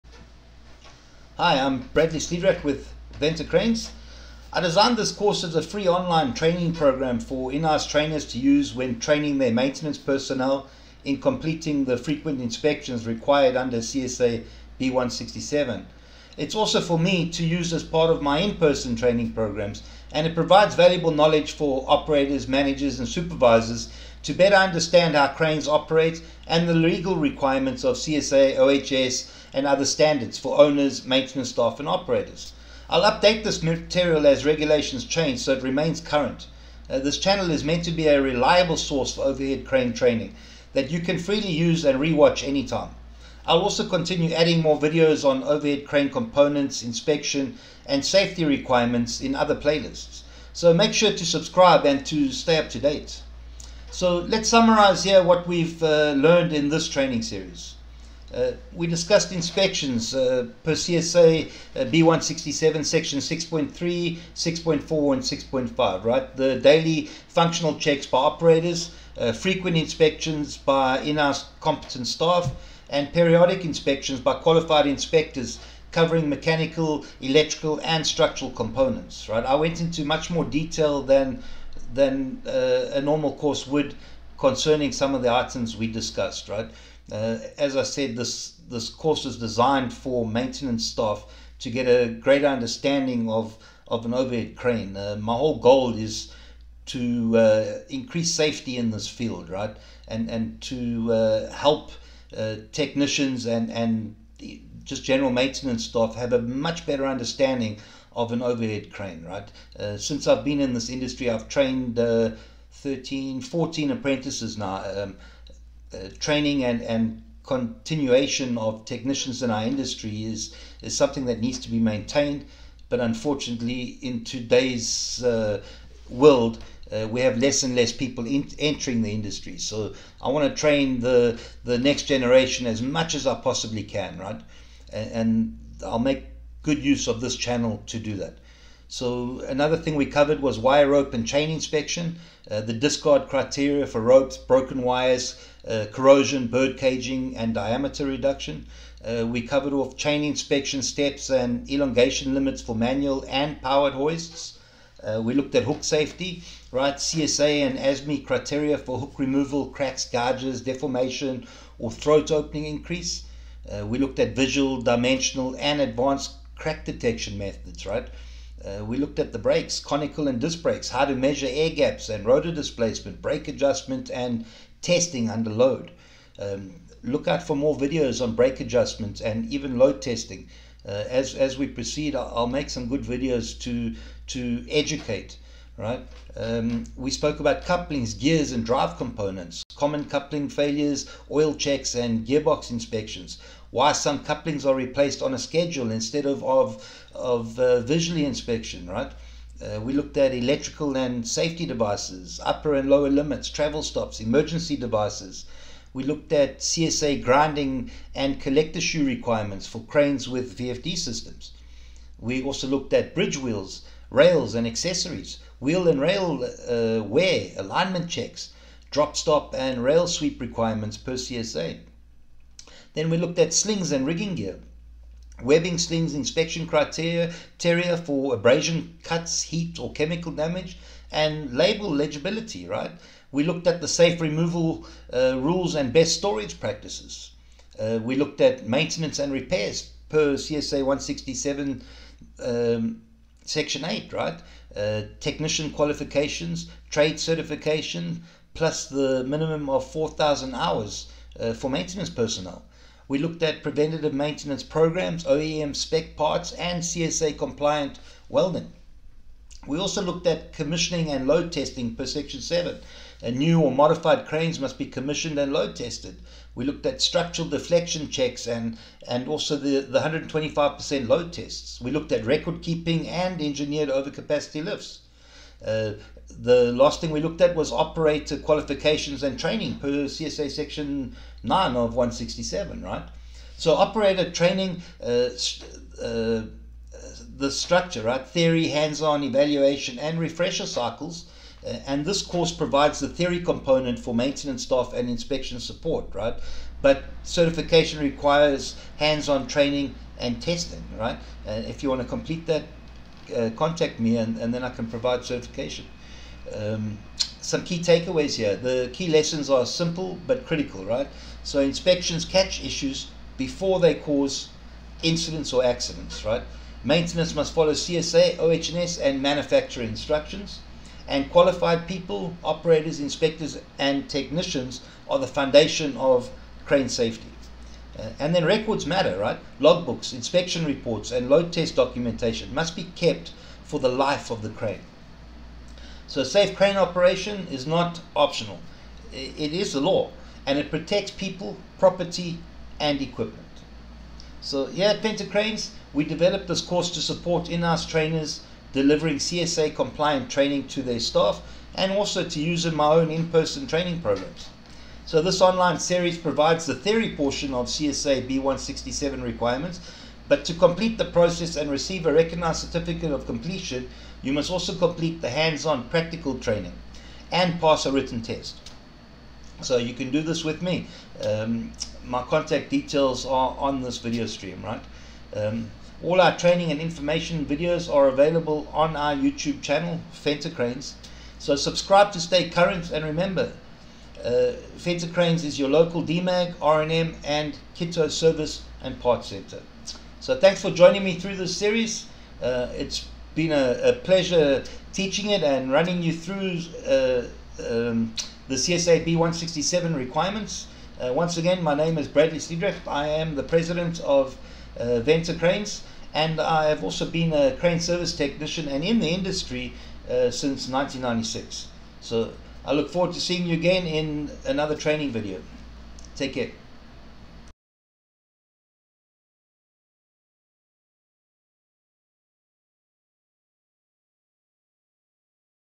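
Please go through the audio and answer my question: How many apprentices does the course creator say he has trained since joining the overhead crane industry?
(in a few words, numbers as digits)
13 or 14.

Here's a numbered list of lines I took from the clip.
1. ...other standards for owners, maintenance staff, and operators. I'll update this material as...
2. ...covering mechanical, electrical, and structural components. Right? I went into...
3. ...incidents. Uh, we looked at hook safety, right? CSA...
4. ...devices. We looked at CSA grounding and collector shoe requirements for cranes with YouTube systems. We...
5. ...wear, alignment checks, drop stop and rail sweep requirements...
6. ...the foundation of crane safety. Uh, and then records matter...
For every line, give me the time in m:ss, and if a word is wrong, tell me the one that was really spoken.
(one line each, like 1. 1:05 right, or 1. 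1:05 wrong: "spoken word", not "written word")
1. 0:29 right
2. 1:15 right
3. 2:33 wrong: "hoists", not "incidents"
4. 3:24 wrong: "VFD", not "YouTube"
5. 3:37 right
6. 5:25 right.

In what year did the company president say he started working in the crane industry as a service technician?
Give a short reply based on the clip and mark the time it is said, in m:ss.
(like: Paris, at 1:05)
1996, at 6:50.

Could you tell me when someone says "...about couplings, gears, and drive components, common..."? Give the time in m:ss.
3:07.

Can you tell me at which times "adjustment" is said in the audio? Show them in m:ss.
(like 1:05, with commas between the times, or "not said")
2:53, 2:58.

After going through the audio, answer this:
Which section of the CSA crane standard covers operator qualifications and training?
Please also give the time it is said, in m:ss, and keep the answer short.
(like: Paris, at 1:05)
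Section 9, at 4:40.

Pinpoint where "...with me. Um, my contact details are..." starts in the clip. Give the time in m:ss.
6:10.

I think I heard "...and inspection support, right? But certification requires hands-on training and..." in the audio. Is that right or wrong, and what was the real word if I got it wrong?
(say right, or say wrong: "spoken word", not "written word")
right.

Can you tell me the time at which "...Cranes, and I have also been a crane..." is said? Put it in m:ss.
6:45.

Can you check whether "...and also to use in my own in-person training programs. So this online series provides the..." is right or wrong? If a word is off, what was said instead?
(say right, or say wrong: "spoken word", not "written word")
right.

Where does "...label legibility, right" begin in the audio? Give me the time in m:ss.
3:51.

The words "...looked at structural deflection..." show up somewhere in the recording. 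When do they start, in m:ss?
4:26.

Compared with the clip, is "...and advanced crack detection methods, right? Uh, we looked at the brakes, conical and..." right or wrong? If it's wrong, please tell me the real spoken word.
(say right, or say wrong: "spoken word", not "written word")
right.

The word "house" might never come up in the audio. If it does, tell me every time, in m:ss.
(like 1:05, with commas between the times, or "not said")
0:07, 1:11, 5:47.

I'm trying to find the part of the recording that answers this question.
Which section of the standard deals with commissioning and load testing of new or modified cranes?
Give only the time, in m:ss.
4:22.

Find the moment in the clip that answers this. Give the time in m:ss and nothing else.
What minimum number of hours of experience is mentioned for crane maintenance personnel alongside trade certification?
4:09.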